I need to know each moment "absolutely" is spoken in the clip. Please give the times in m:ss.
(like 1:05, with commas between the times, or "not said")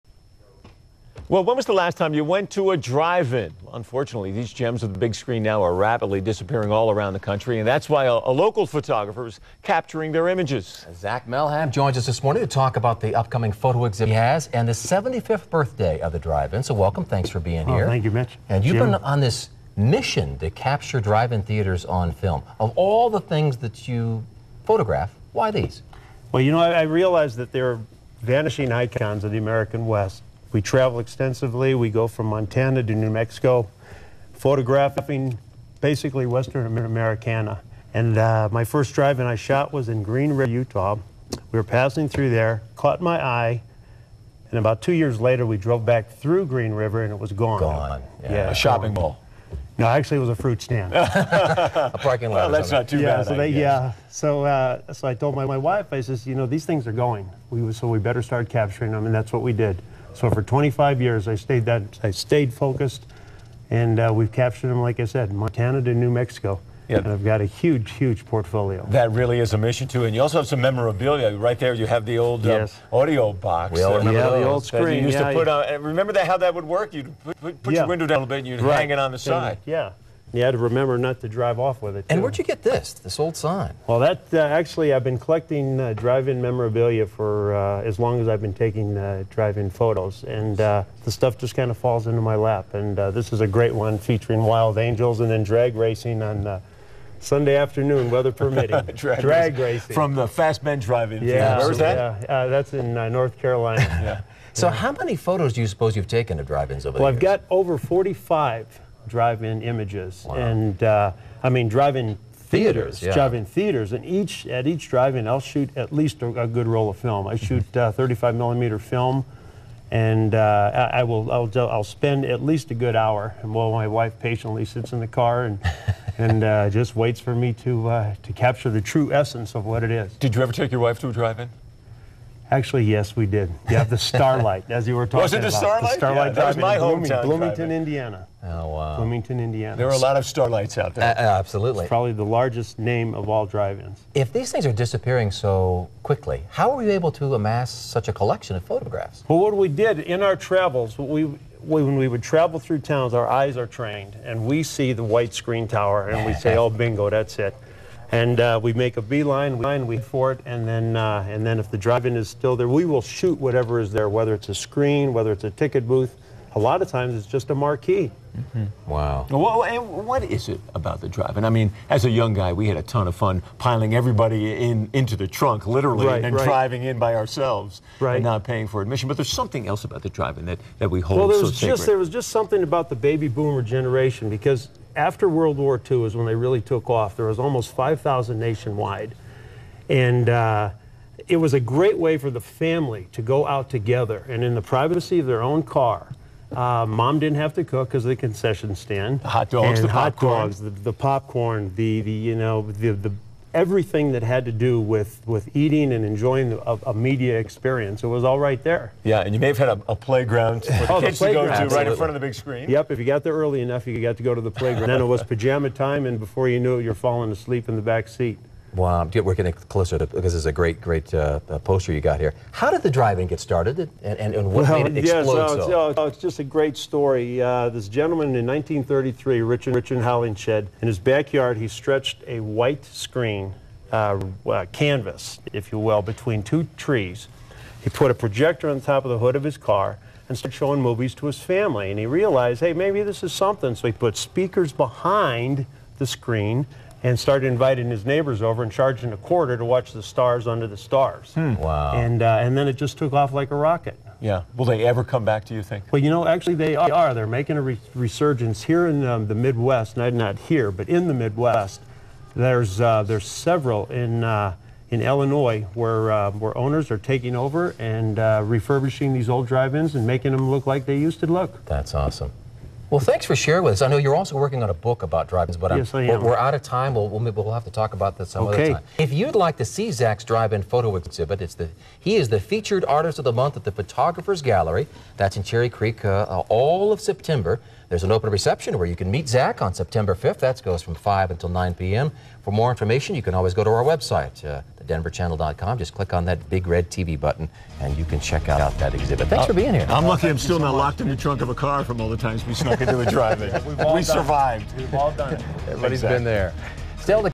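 2:21, 3:31.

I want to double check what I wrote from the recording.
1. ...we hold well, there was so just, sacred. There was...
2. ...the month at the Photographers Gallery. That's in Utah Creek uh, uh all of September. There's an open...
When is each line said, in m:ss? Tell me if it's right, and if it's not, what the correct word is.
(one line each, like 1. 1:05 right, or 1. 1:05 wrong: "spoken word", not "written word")
1. 3:00 right
2. 4:43 wrong: "Cherry", not "Utah".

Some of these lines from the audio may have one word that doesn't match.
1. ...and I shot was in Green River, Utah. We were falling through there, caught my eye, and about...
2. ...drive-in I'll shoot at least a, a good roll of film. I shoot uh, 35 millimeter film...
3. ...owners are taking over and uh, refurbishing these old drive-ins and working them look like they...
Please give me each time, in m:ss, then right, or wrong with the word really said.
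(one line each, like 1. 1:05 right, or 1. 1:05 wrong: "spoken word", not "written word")
1. 0:38 wrong: "passing", not "falling"
2. 1:54 right
3. 4:26 wrong: "making", not "working".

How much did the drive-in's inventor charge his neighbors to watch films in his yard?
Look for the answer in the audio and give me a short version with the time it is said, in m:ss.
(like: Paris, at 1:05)
A quarter, at 4:09.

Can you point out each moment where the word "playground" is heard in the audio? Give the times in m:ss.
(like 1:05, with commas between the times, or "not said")
3:29, 3:34.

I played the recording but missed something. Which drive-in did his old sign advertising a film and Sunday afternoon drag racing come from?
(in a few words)
Fast Men Drive-In.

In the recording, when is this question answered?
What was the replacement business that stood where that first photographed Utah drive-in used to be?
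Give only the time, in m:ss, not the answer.
0:50.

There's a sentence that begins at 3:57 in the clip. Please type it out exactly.
He put a projector on the top of the hood of his car and started showing movies to his family.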